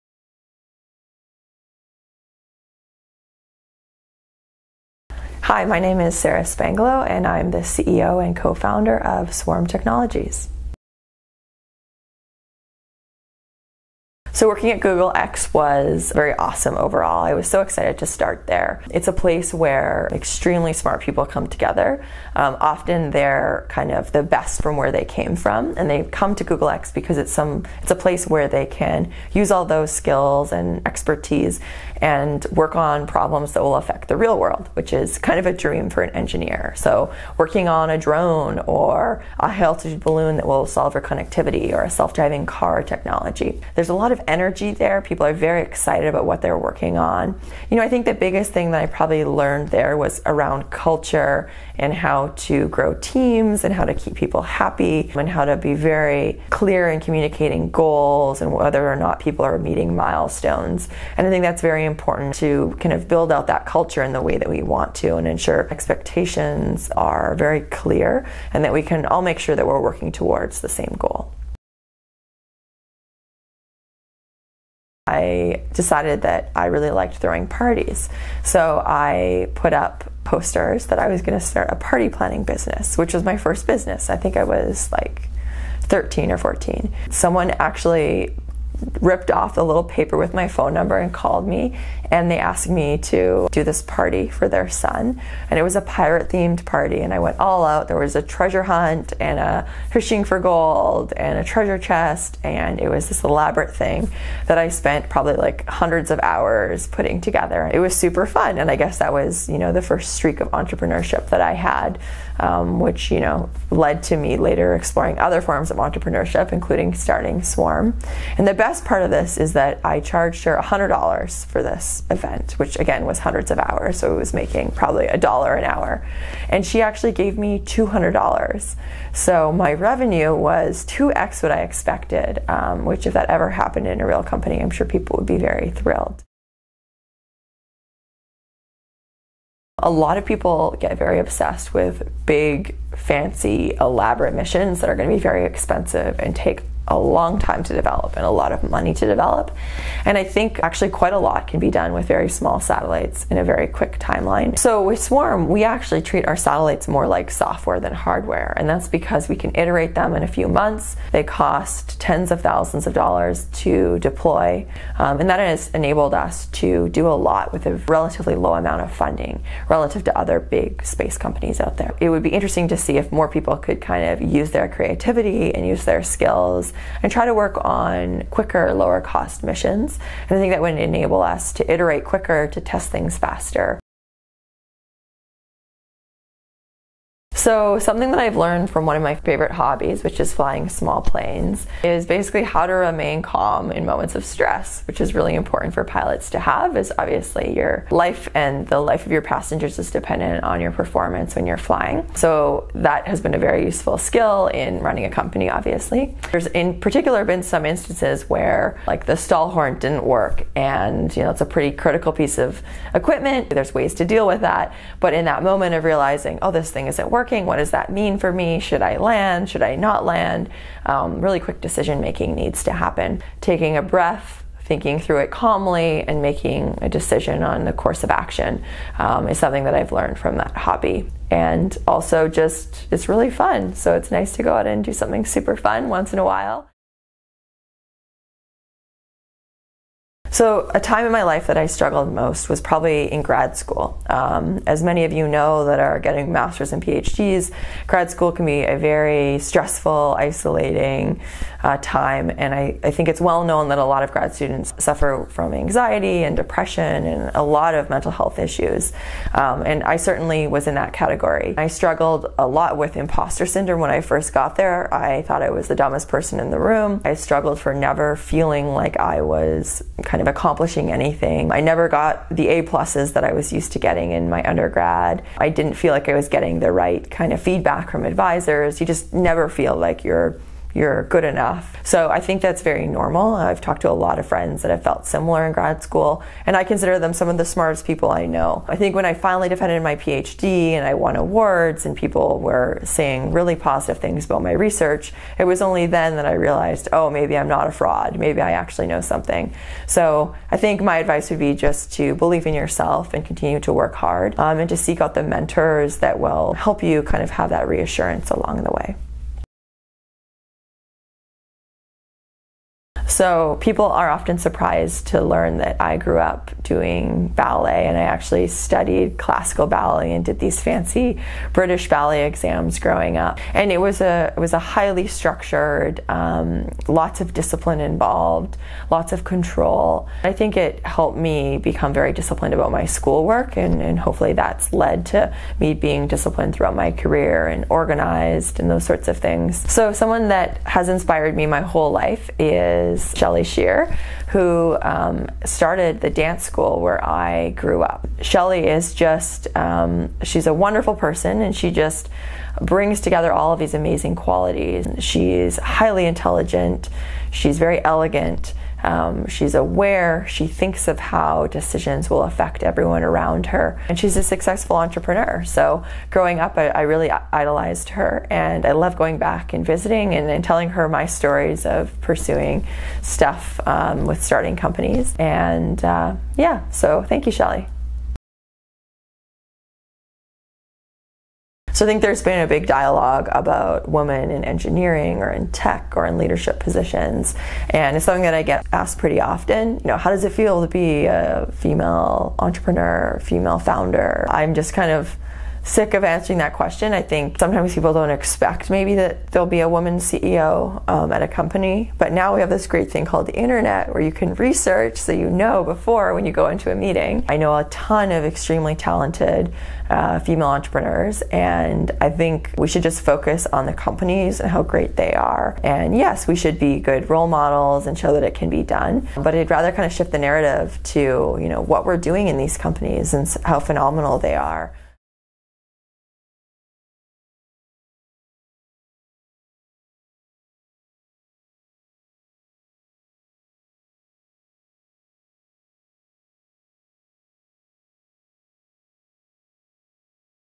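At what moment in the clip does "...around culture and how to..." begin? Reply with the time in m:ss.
0:50.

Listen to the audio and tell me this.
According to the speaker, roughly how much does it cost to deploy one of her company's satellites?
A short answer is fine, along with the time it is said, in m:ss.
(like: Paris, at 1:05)
Tens of thousands of dollars, at 2:42.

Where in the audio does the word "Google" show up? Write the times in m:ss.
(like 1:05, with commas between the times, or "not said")
0:14, 0:26.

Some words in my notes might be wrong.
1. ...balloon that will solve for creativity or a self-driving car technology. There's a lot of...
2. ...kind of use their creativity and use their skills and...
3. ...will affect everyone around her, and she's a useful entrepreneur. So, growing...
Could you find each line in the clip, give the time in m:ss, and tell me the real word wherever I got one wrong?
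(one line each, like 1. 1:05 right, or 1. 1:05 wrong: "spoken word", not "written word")
1. 0:39 wrong: "connectivity", not "creativity"
2. 2:53 right
3. 6:02 wrong: "successful", not "useful".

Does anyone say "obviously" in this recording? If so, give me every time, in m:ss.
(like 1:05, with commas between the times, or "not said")
3:16, 3:25.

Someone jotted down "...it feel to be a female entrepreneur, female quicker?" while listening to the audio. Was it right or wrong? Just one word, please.
wrong.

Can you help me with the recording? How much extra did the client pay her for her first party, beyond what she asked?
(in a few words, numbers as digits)
$200.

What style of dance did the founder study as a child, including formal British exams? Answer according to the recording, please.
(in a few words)
Classical ballet.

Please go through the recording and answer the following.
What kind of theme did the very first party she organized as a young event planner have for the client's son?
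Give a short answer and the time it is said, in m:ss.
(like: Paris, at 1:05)
Pirate, at 1:35.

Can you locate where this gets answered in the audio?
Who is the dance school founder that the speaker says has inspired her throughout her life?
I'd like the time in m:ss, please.
5:43.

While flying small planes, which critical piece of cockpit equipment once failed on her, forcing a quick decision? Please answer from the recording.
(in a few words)
Stall horn.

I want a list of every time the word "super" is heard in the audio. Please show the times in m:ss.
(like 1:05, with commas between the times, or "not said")
1:47, 3:55.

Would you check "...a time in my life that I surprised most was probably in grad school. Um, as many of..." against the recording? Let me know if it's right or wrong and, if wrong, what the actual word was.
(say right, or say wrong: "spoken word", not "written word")
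wrong: "struggled", not "surprised".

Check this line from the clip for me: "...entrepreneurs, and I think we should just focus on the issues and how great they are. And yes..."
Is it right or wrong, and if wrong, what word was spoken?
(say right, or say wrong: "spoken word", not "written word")
wrong: "companies", not "issues".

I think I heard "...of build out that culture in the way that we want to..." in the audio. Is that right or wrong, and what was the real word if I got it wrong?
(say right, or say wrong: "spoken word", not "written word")
right.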